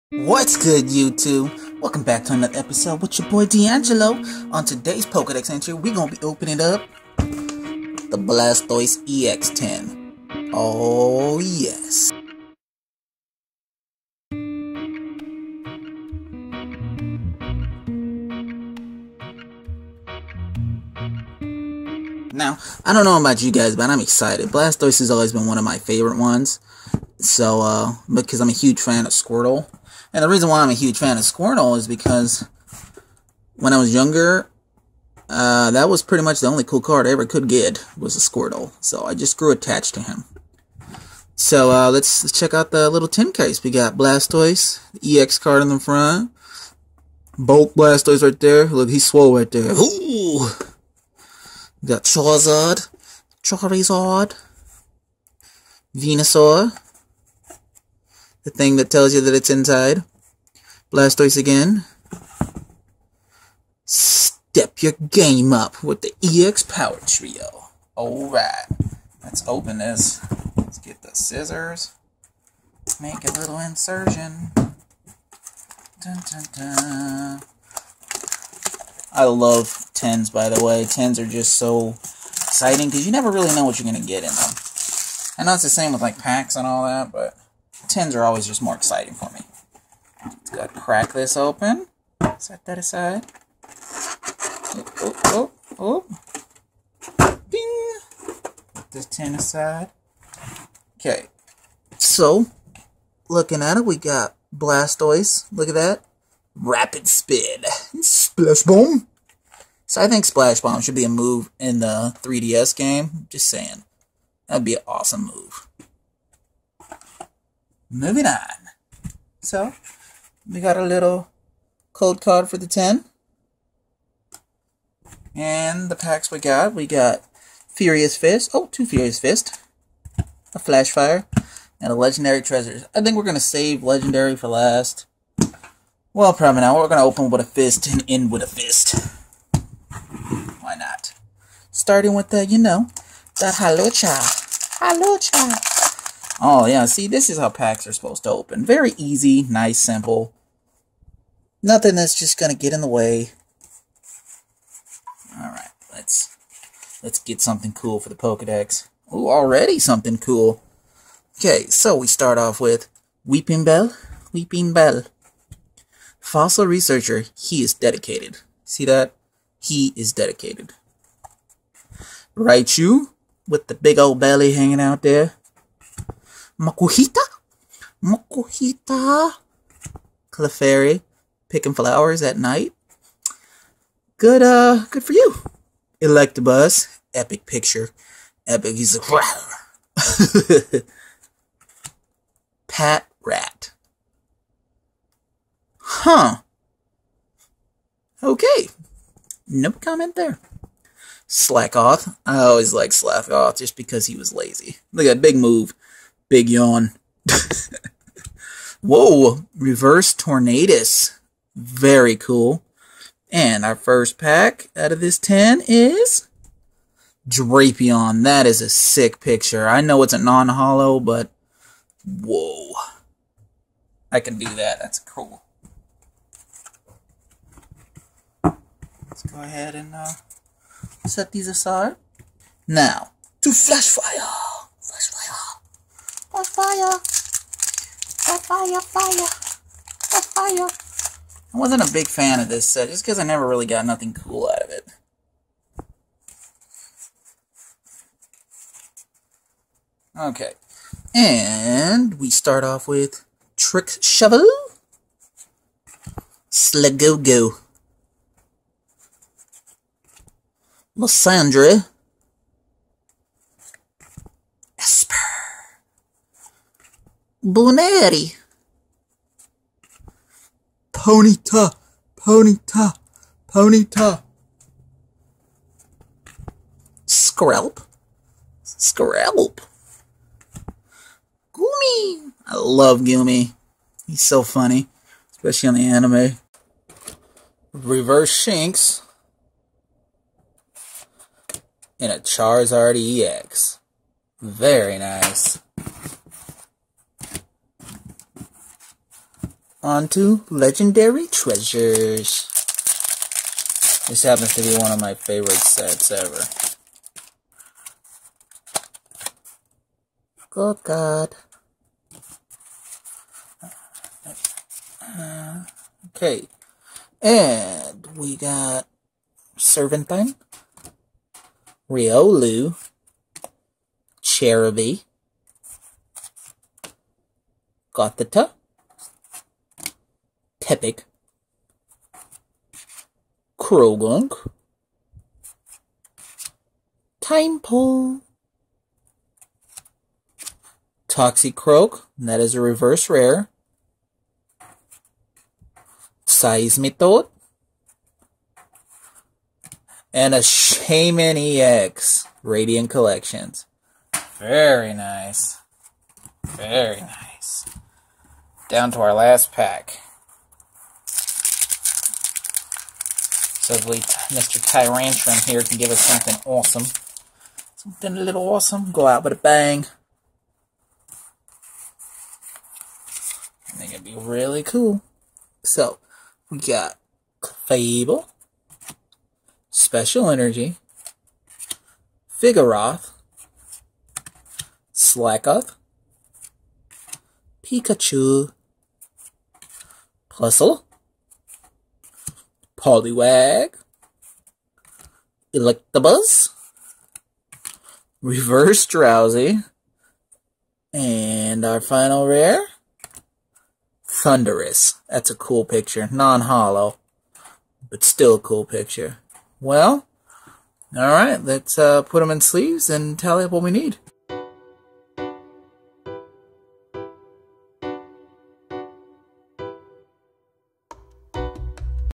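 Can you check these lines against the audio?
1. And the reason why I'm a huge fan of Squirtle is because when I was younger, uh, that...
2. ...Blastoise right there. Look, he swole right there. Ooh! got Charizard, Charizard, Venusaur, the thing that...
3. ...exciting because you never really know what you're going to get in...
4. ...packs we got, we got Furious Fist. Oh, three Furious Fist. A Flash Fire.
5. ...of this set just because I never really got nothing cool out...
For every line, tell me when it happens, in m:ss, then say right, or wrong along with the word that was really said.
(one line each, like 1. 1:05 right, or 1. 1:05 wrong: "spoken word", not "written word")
1. 0:30 right
2. 0:47 right
3. 1:21 right
4. 2:05 wrong: "two", not "three"
5. 4:02 right.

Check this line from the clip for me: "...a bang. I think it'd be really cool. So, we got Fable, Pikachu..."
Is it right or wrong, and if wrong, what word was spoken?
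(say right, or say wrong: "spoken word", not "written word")
wrong: "Special", not "Pikachu".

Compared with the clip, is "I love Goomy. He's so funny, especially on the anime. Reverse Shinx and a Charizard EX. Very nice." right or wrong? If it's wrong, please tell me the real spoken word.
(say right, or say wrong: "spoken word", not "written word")
right.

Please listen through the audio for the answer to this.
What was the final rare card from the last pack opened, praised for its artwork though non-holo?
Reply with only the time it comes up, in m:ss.
6:44.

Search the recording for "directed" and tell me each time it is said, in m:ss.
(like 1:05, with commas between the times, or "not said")
not said.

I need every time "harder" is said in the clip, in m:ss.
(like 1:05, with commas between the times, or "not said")
not said.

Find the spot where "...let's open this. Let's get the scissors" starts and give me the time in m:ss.
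1:09.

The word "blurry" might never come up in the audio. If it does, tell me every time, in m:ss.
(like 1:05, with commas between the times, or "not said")
not said.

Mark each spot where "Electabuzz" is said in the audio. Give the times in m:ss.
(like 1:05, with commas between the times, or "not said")
3:05, 6:35.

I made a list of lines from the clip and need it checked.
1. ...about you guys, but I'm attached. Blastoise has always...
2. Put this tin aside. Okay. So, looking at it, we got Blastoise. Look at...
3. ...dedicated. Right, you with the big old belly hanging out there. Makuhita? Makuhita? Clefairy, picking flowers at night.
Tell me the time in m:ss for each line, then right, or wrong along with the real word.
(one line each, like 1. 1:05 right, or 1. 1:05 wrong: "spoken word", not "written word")
1. 0:23 wrong: "excited", not "attached"
2. 1:38 right
3. 2:50 right.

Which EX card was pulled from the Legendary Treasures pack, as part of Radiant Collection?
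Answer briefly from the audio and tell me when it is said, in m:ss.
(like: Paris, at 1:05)
Shaymin EX, at 5:50.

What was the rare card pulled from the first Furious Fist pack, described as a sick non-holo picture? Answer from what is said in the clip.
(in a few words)
Drapion.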